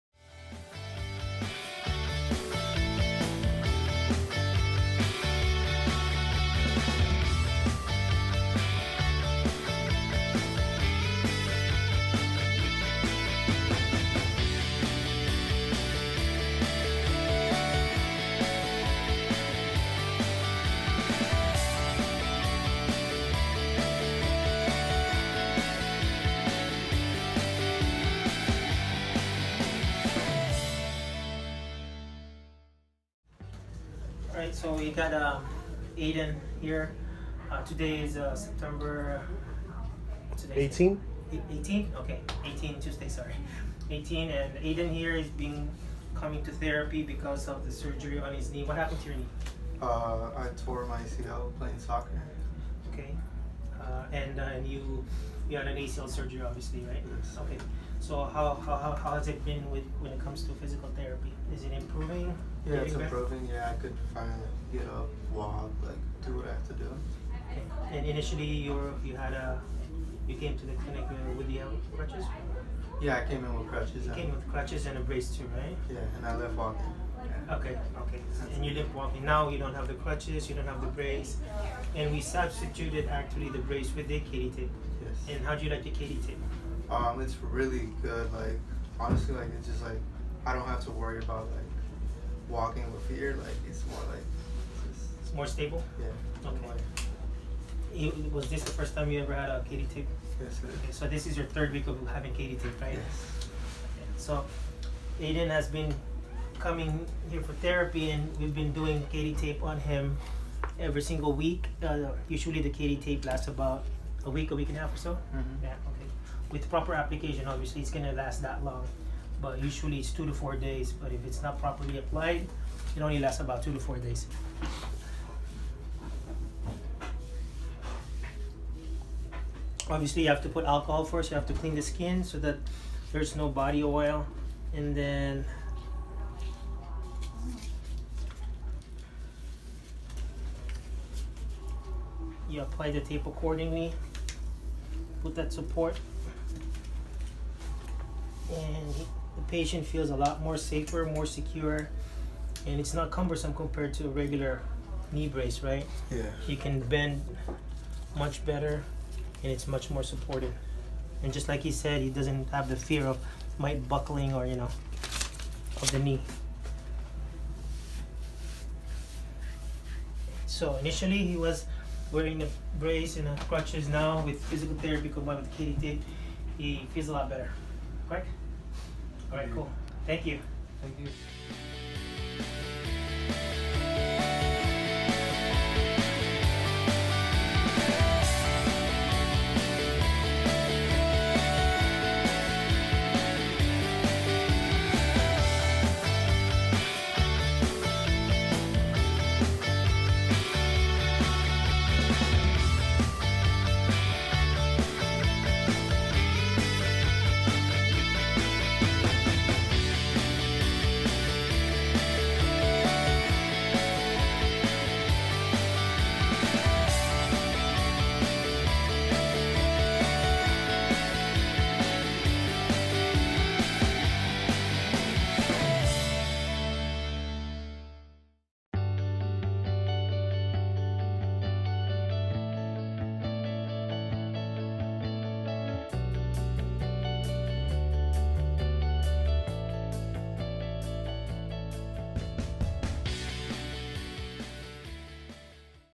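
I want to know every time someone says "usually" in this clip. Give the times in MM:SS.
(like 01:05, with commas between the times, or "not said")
01:52, 01:59.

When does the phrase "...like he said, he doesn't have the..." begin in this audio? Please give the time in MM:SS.
02:41.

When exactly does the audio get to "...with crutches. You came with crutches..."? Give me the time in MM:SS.
01:13.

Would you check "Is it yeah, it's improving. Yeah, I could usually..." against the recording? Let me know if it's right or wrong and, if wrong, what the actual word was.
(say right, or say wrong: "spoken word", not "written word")
wrong: "finally", not "usually".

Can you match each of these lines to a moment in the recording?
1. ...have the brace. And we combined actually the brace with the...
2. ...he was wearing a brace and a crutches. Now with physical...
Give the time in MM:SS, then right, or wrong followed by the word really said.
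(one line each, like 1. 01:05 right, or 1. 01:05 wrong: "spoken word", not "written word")
1. 01:20 wrong: "substituted", not "combined"
2. 02:51 right.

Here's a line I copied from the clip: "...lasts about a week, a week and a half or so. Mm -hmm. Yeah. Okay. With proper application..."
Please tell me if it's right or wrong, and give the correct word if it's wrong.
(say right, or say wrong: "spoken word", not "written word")
right.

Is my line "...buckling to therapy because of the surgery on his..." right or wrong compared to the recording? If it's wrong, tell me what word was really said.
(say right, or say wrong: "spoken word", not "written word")
wrong: "coming", not "buckling".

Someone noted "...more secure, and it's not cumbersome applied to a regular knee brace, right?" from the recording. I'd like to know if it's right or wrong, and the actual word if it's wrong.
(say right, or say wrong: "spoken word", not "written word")
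wrong: "compared", not "applied".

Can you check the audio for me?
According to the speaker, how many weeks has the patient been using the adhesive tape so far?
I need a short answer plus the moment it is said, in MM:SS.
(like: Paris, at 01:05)
third week, at 01:41.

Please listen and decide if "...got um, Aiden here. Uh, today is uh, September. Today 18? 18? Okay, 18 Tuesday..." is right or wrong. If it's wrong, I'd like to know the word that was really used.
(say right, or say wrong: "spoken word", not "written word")
right.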